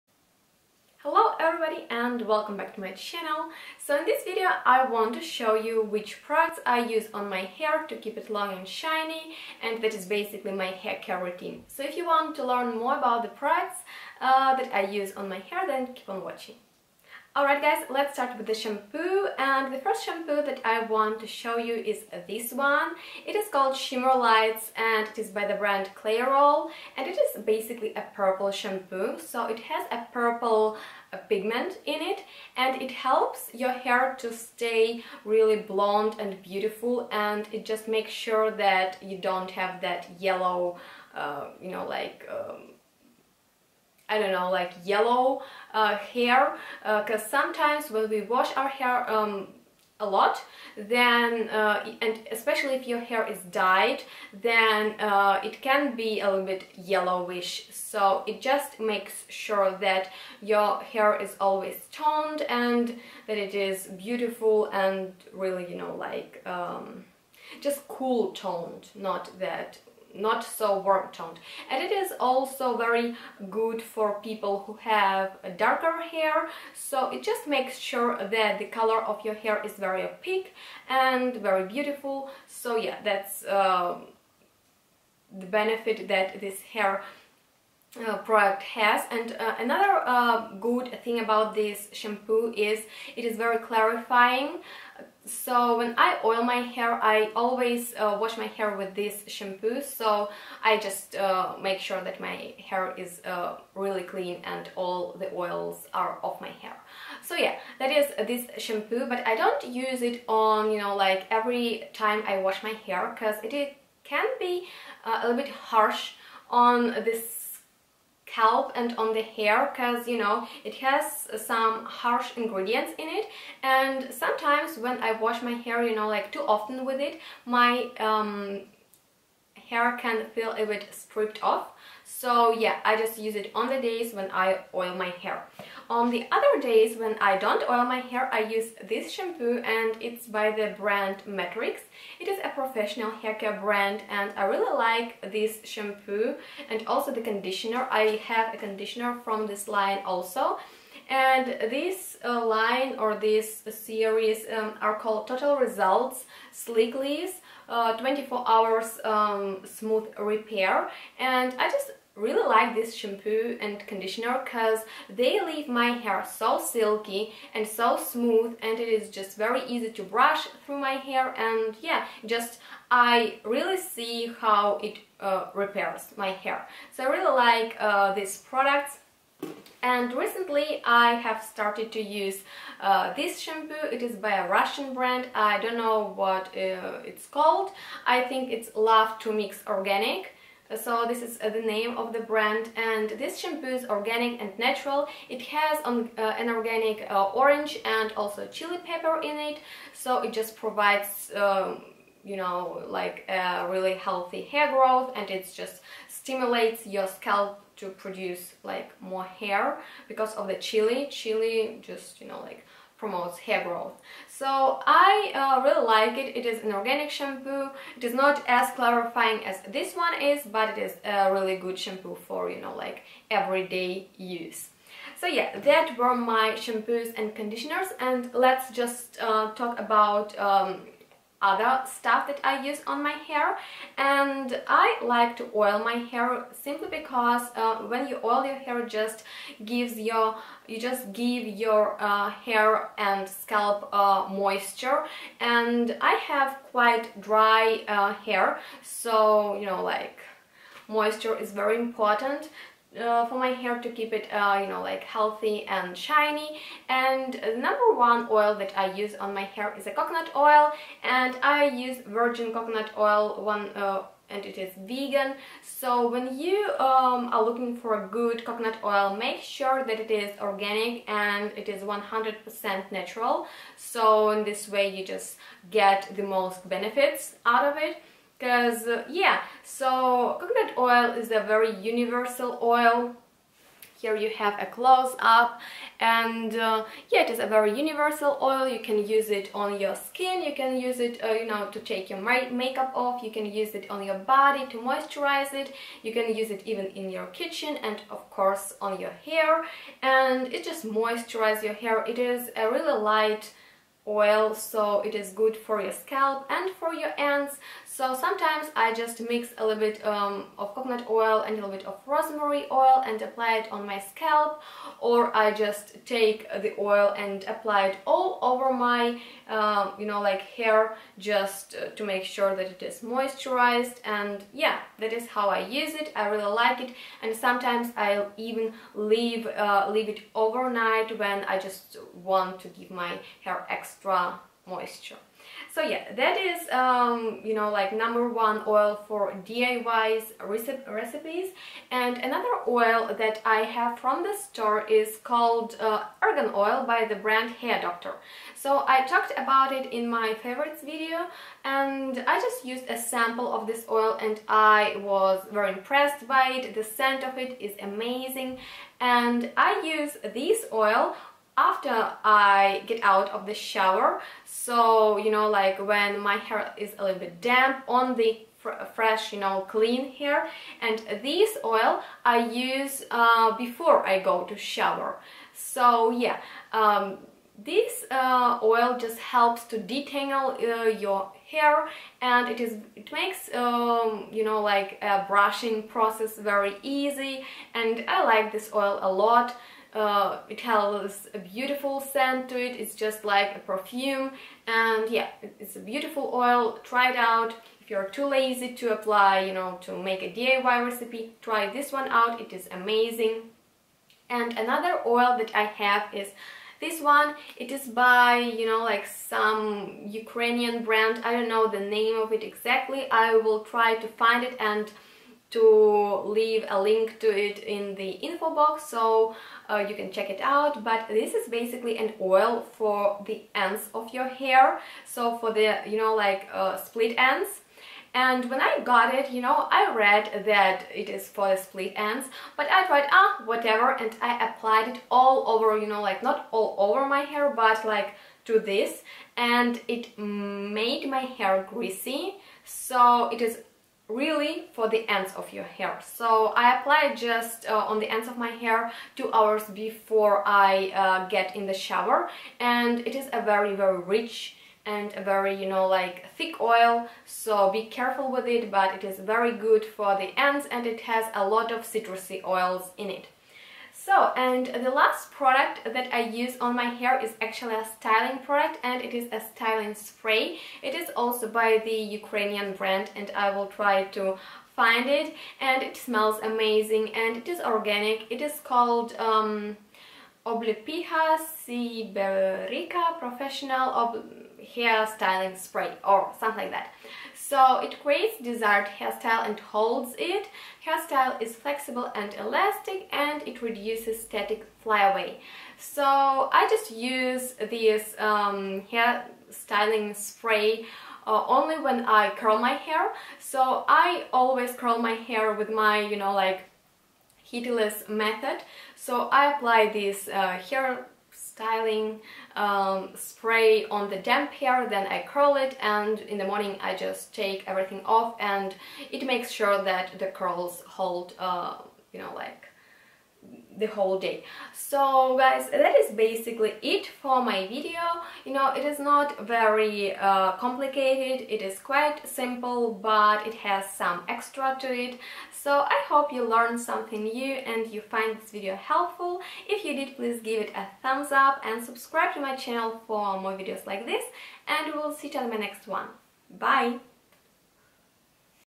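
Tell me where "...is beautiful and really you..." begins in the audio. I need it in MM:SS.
01:03.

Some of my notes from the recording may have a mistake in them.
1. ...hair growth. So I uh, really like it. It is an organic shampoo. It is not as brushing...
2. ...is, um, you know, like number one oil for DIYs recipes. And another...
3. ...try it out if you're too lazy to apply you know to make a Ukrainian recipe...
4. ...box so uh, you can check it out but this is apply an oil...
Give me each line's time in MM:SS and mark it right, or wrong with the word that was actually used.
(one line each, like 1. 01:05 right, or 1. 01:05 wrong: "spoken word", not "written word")
1. 03:33 wrong: "clarifying", not "brushing"
2. 05:36 right
3. 06:36 wrong: "DIY", not "Ukrainian"
4. 06:58 wrong: "basically", not "apply".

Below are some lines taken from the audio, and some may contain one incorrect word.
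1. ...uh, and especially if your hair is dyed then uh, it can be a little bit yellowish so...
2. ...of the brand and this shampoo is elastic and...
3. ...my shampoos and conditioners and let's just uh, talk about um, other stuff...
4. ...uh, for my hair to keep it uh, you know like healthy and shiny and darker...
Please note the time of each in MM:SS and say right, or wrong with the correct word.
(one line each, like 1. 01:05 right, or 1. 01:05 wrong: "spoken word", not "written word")
1. 00:51 right
2. 03:11 wrong: "organic", not "elastic"
3. 03:46 right
4. 04:12 wrong: "number", not "darker".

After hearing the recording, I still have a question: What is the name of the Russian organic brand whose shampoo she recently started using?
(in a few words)
Love to Mix Organic.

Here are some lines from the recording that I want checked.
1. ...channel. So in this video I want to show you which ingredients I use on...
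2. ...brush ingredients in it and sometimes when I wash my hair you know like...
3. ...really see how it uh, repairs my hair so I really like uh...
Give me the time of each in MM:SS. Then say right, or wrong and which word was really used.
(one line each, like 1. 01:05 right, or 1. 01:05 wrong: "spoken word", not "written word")
1. 00:02 wrong: "products", not "ingredients"
2. 02:01 wrong: "harsh", not "brush"
3. 02:53 right.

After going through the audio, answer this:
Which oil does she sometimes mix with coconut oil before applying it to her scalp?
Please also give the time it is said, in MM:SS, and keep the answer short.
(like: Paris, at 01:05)
rosemary oil, at 05:12.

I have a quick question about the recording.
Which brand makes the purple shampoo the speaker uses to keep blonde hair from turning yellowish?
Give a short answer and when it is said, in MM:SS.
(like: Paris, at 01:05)
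Clairol, at 00:25.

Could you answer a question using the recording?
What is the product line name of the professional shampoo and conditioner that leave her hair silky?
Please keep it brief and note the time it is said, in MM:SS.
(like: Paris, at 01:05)
Total Results Sleek, at 02:35.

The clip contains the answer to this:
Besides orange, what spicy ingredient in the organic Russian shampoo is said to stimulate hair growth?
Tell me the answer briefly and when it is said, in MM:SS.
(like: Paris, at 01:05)
chili pepper, at 03:18.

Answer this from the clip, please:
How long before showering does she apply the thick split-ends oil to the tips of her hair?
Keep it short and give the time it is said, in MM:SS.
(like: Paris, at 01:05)
2 hours, at 07:29.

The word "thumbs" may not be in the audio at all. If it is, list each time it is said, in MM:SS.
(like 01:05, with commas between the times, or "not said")
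09:01.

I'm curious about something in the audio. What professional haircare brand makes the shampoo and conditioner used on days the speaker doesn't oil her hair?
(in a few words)
Matrix.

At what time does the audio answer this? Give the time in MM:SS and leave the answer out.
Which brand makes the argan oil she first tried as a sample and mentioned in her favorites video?
05:47.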